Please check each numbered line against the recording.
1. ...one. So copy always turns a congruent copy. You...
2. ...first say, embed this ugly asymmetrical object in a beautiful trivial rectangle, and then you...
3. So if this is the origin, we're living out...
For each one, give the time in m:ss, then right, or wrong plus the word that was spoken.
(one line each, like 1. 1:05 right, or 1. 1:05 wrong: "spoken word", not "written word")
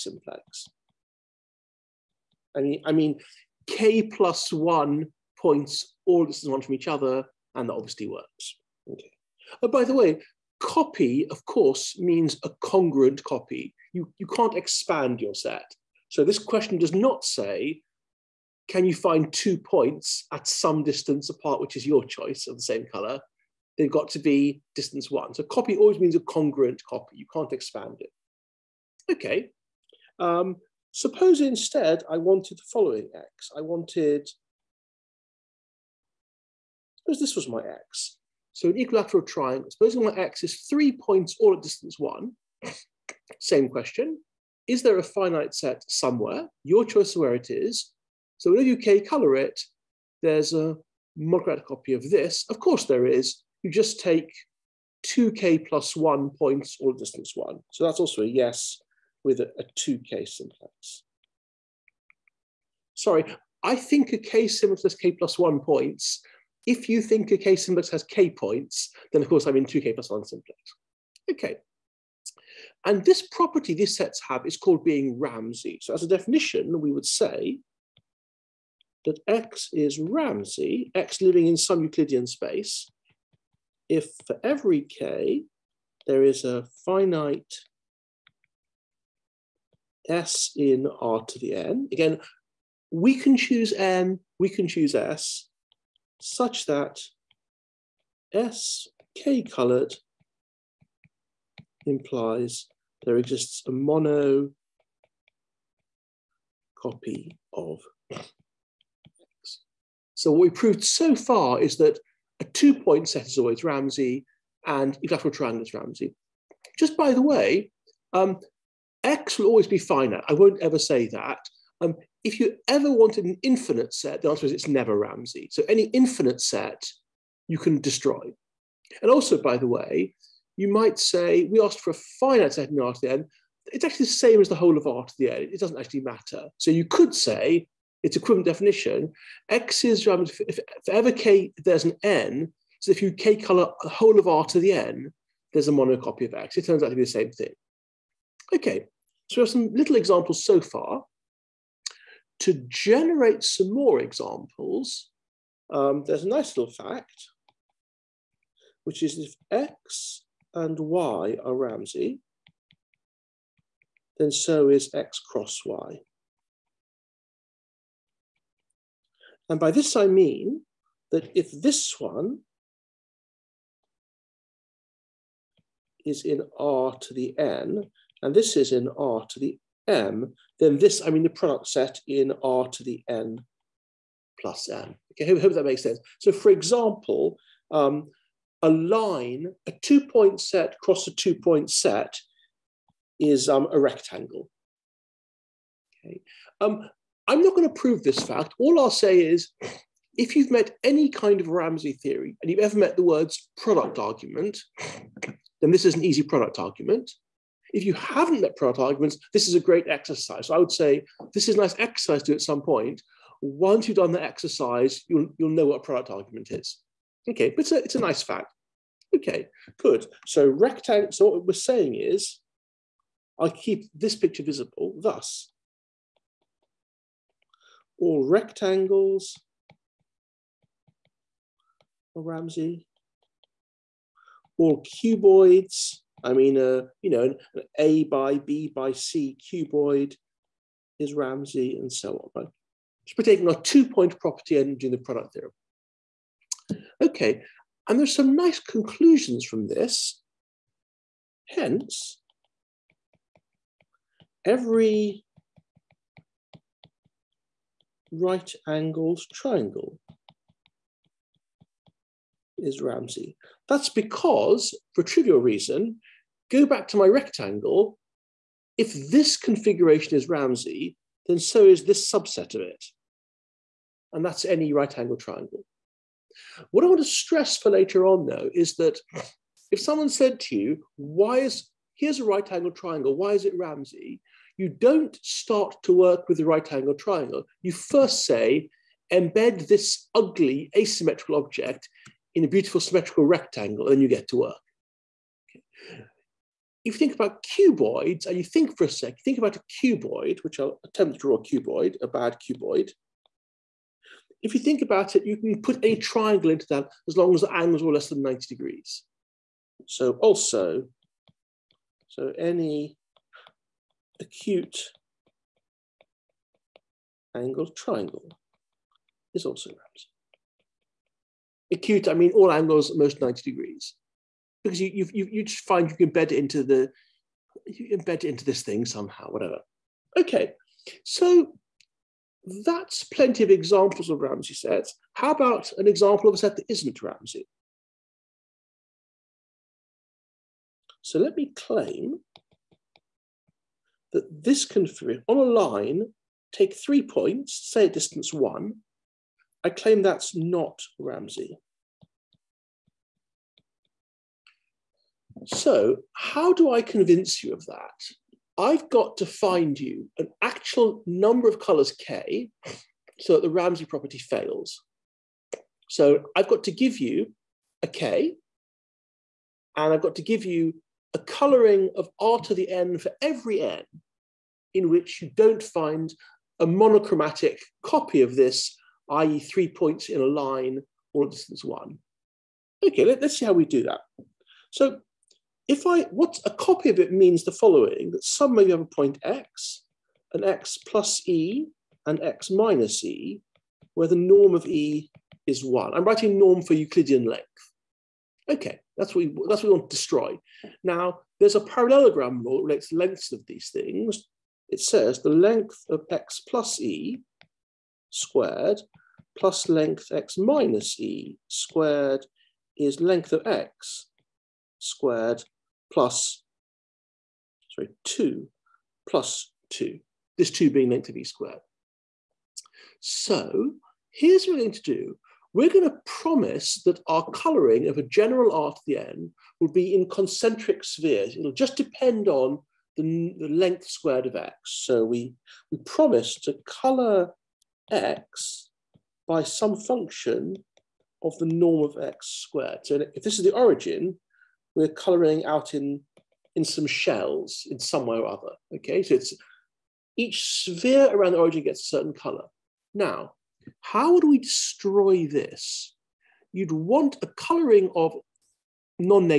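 1. 0:25 wrong: "means", not "turns"
2. 4:47 wrong: "symmetrical", not "trivial"
3. 7:22 wrong: "colouring", not "living".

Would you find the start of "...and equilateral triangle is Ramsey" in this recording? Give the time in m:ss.
1:54.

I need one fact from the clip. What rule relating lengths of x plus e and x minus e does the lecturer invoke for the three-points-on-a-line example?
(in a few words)
Parallelogram rule.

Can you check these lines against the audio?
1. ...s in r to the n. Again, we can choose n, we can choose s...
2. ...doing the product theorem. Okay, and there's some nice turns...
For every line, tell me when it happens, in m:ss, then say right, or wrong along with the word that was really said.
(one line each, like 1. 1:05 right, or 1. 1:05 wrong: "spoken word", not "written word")
1. 1:30 right
2. 4:04 wrong: "conclusions", not "turns".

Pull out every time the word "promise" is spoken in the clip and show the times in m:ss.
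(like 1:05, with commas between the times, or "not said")
7:06, 7:15.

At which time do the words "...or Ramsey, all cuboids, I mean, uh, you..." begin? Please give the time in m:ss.
3:52.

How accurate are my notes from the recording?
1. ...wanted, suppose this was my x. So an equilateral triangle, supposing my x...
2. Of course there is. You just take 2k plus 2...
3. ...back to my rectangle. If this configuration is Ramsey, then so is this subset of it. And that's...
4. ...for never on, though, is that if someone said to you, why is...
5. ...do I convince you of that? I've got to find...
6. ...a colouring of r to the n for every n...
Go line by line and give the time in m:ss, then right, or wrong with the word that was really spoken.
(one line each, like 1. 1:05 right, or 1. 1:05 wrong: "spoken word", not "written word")
1. 0:33 right
2. 0:52 wrong: "1", not "2"
3. 4:26 right
4. 4:37 wrong: "later", not "never"
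5. 5:56 right
6. 6:11 right.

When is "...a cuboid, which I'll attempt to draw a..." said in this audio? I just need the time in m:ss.
4:59.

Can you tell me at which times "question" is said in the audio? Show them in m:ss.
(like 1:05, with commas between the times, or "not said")
0:16, 0:43.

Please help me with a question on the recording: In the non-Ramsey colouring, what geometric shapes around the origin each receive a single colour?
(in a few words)
Concentric spheres.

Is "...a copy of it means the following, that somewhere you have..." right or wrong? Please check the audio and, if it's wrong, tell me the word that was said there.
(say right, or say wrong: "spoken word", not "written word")
right.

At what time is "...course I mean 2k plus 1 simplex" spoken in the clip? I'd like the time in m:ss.
1:09.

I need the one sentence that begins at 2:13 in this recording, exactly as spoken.
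It's actually the same as the whole of R to the n.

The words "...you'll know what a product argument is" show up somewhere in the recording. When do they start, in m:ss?
3:35.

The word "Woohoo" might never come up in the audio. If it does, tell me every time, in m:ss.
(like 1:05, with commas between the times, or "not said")
not said.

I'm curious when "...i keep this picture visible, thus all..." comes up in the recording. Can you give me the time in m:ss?
3:43.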